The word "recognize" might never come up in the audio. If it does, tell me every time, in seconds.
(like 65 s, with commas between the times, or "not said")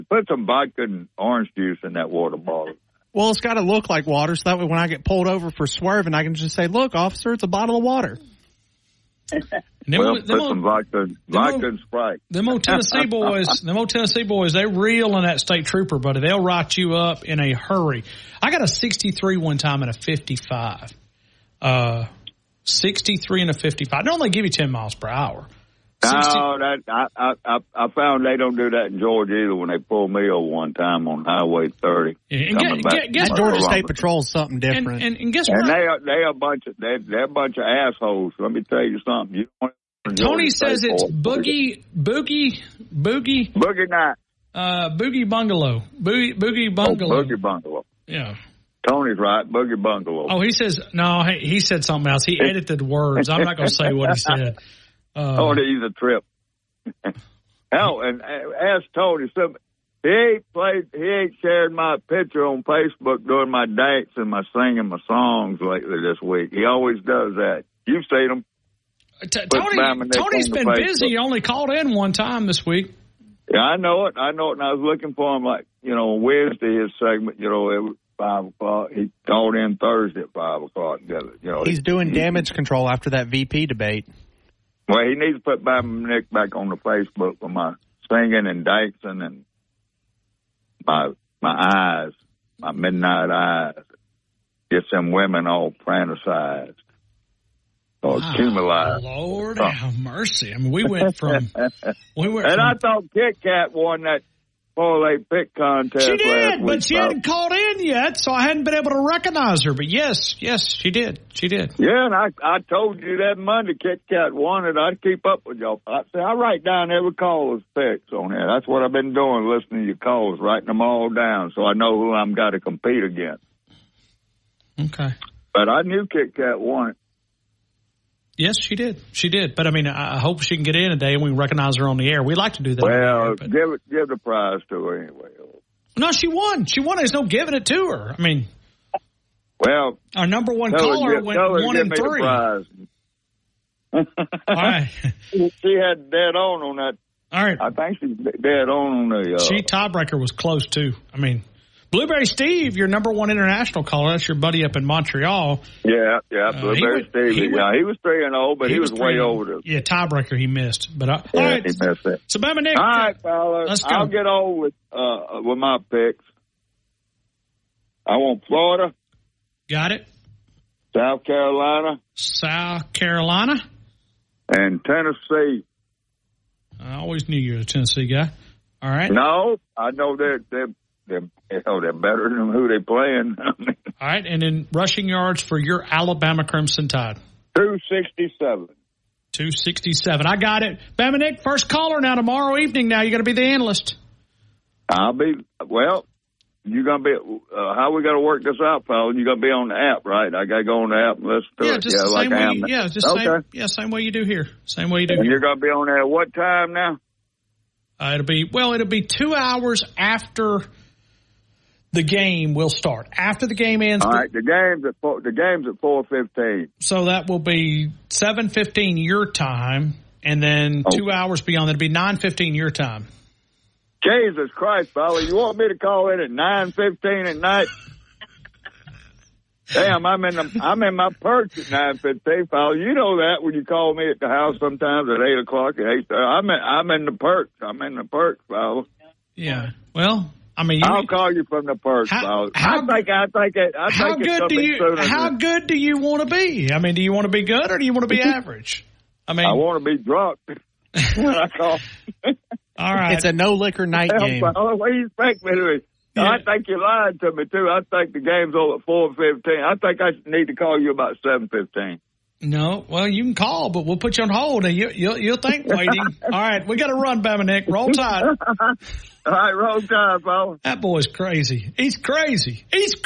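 109 s, 131 s.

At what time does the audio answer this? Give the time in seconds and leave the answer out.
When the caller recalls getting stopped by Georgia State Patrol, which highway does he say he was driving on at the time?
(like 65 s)
31 s.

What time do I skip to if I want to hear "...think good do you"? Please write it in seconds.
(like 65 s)
244 s.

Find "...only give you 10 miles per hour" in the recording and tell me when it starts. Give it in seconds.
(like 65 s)
24 s.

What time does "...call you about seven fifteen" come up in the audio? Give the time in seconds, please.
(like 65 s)
260 s.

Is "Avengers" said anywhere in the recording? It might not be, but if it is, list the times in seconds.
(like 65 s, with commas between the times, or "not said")
not said.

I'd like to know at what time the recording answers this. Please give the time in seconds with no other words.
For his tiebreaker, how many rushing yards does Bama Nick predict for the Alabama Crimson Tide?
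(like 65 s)
187 s.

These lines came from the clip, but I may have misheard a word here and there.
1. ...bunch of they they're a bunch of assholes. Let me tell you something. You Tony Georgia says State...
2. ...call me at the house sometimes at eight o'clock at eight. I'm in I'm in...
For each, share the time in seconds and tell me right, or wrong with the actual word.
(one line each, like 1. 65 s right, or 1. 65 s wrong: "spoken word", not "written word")
1. 36 s right
2. 233 s right.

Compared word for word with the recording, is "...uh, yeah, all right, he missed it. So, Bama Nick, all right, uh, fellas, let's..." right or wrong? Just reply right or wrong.
right.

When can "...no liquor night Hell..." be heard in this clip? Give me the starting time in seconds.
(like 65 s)
253 s.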